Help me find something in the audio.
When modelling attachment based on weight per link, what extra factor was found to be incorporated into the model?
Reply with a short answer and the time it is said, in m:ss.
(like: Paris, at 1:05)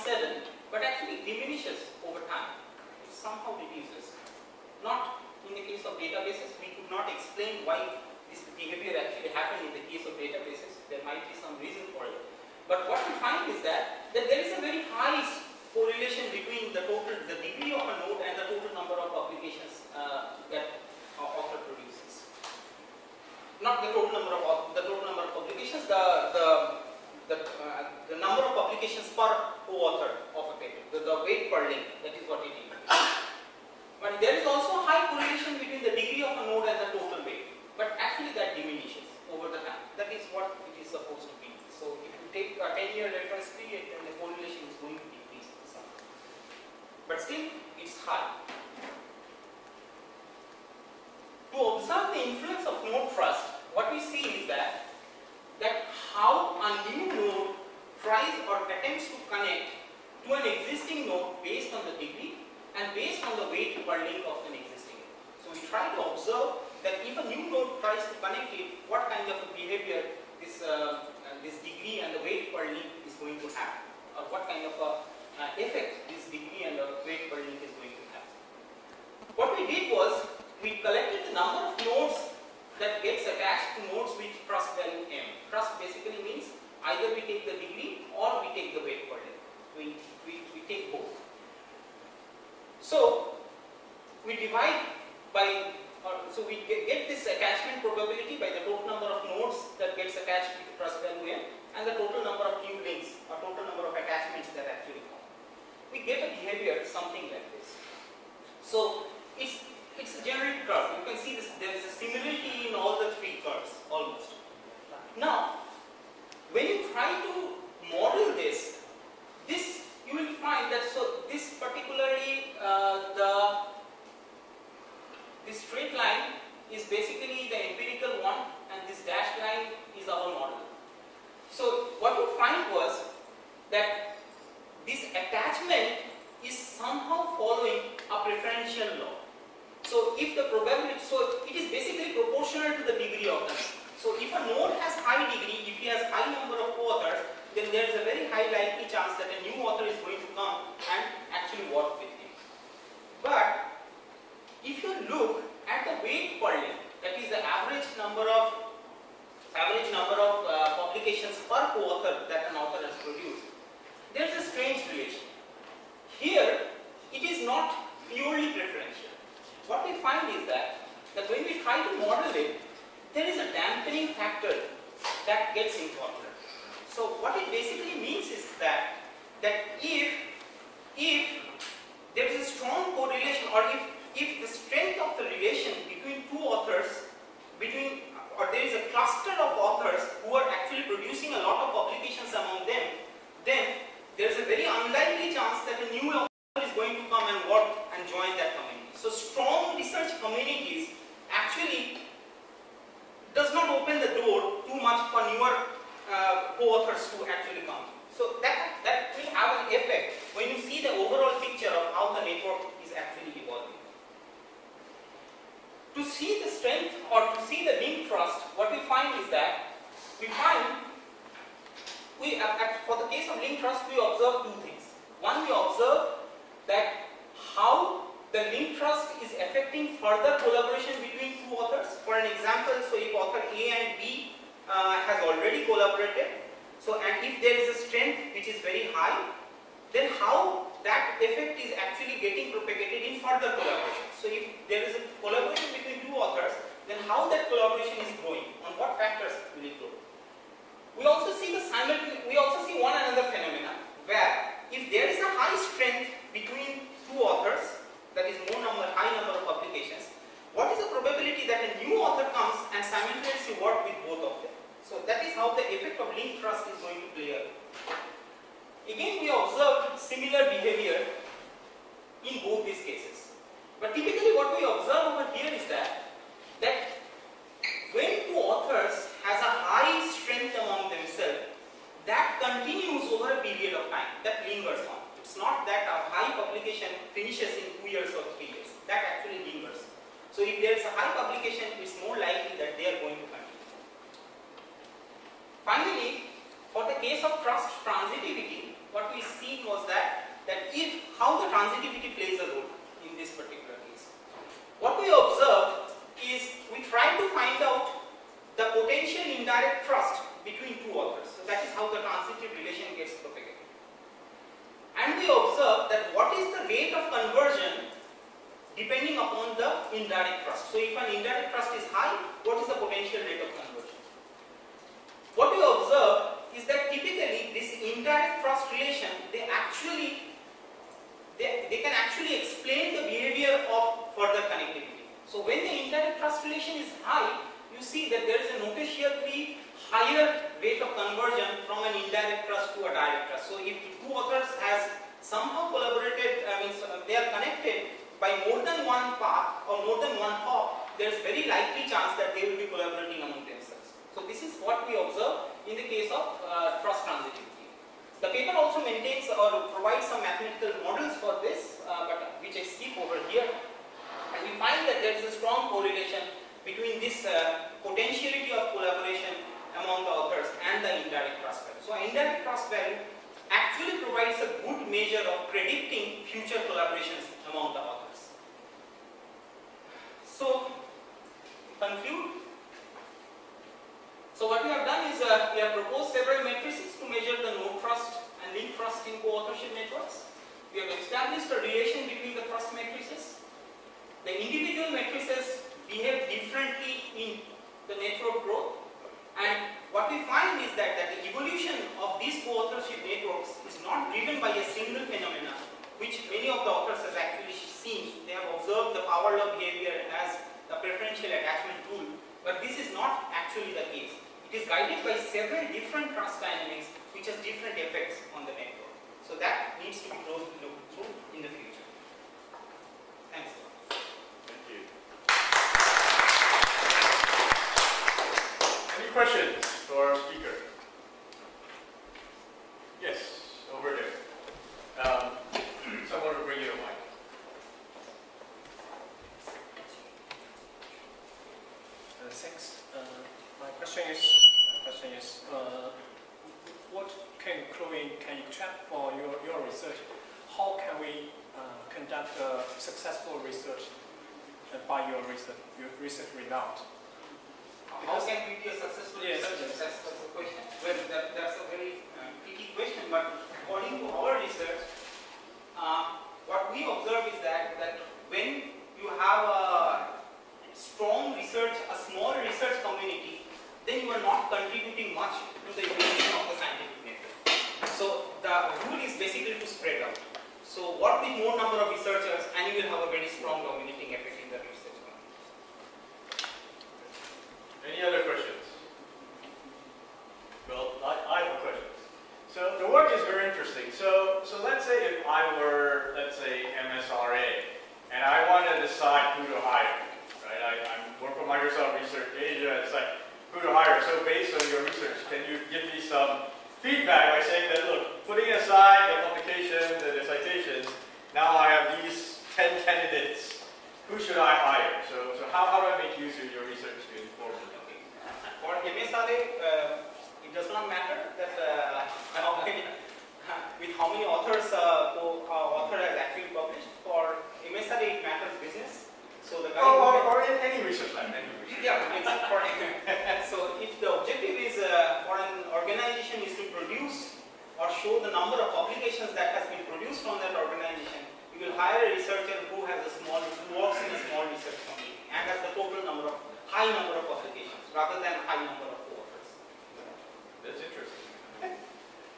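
dampening factor, at 2:53.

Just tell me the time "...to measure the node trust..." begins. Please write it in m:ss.
6:27.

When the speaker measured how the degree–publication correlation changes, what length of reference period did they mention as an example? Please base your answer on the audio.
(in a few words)
10 year.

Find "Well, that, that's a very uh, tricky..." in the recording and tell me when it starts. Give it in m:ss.
7:40.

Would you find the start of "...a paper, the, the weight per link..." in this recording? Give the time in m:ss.
0:30.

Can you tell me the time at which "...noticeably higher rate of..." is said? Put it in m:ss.
5:38.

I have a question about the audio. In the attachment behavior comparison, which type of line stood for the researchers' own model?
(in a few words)
dashed line.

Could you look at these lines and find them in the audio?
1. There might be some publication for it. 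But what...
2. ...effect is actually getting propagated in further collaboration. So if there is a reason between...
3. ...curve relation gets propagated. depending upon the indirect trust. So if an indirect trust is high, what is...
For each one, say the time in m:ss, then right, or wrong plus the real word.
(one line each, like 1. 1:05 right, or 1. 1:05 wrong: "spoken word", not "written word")
1. 0:10 wrong: "reason", not "publication"
2. 4:01 wrong: "collaboration", not "reason"
3. 5:12 wrong: "transitive", not "curve".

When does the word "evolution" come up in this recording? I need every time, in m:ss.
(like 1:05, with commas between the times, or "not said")
6:41, 7:55.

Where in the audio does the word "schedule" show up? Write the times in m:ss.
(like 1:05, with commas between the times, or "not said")
not said.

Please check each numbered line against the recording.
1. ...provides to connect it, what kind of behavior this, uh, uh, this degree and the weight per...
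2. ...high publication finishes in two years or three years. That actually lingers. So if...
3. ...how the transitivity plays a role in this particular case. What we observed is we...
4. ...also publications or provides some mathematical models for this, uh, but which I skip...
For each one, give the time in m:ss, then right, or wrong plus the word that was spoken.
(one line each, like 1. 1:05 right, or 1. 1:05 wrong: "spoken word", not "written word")
1. 1:07 wrong: "tries", not "provides"
2. 4:46 right
3. 5:01 right
4. 5:58 wrong: "maintains", not "publications".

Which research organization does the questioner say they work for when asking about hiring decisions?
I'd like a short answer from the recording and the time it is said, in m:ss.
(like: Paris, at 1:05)
Microsoft Research Asia, at 8:21.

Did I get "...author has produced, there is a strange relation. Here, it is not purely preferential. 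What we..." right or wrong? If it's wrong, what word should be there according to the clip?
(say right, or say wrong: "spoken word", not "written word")
right.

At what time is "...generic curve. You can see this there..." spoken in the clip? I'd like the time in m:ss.
1:50.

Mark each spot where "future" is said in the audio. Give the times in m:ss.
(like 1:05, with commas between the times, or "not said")
6:16, 7:01.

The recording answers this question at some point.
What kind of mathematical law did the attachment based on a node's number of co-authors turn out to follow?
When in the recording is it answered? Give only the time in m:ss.
2:18.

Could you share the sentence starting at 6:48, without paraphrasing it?
They have observed the power law behavior as the preferential attachment rule, but this is not actually the case.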